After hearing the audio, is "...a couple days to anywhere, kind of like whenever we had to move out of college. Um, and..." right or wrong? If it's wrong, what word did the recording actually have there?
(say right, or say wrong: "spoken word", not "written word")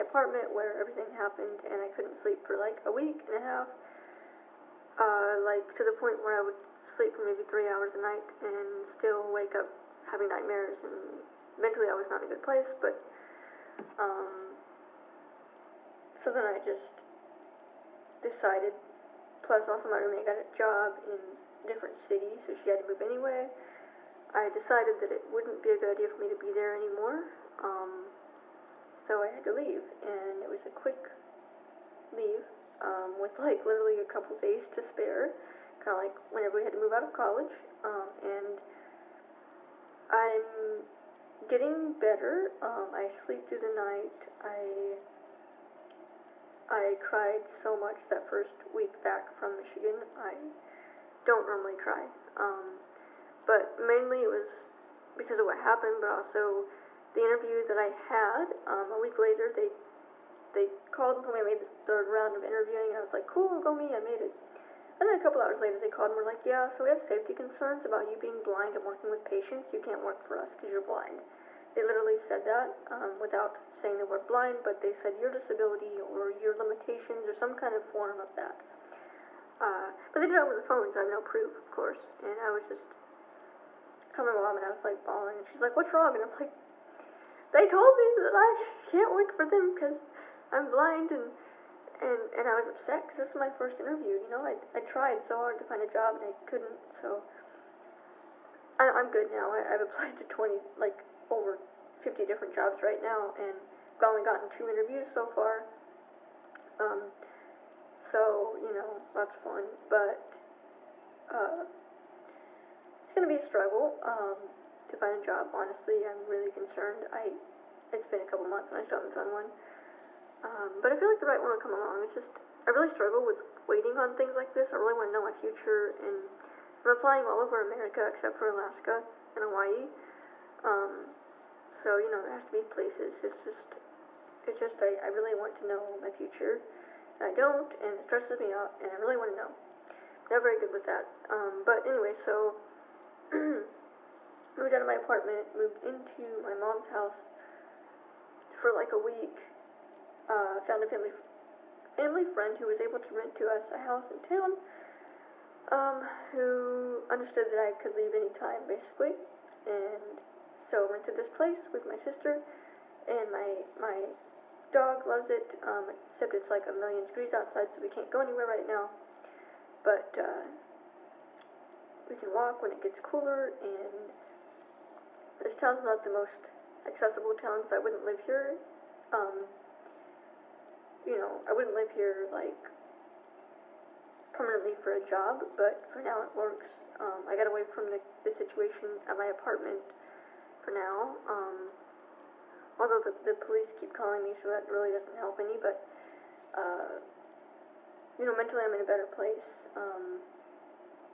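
wrong: "spare", not "anywhere".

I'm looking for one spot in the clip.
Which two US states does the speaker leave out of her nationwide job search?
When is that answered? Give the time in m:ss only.
2:08.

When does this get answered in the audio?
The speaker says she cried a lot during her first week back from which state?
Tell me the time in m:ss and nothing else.
0:49.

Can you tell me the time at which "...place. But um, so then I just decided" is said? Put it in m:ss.
0:12.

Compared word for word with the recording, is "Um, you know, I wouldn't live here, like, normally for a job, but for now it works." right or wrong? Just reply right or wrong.
wrong.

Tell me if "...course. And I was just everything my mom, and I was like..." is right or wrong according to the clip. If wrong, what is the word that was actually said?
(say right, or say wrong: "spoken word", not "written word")
wrong: "telling", not "everything".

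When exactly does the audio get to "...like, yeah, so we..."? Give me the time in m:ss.
1:06.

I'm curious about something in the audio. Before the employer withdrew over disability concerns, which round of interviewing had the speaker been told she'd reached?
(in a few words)
Third round.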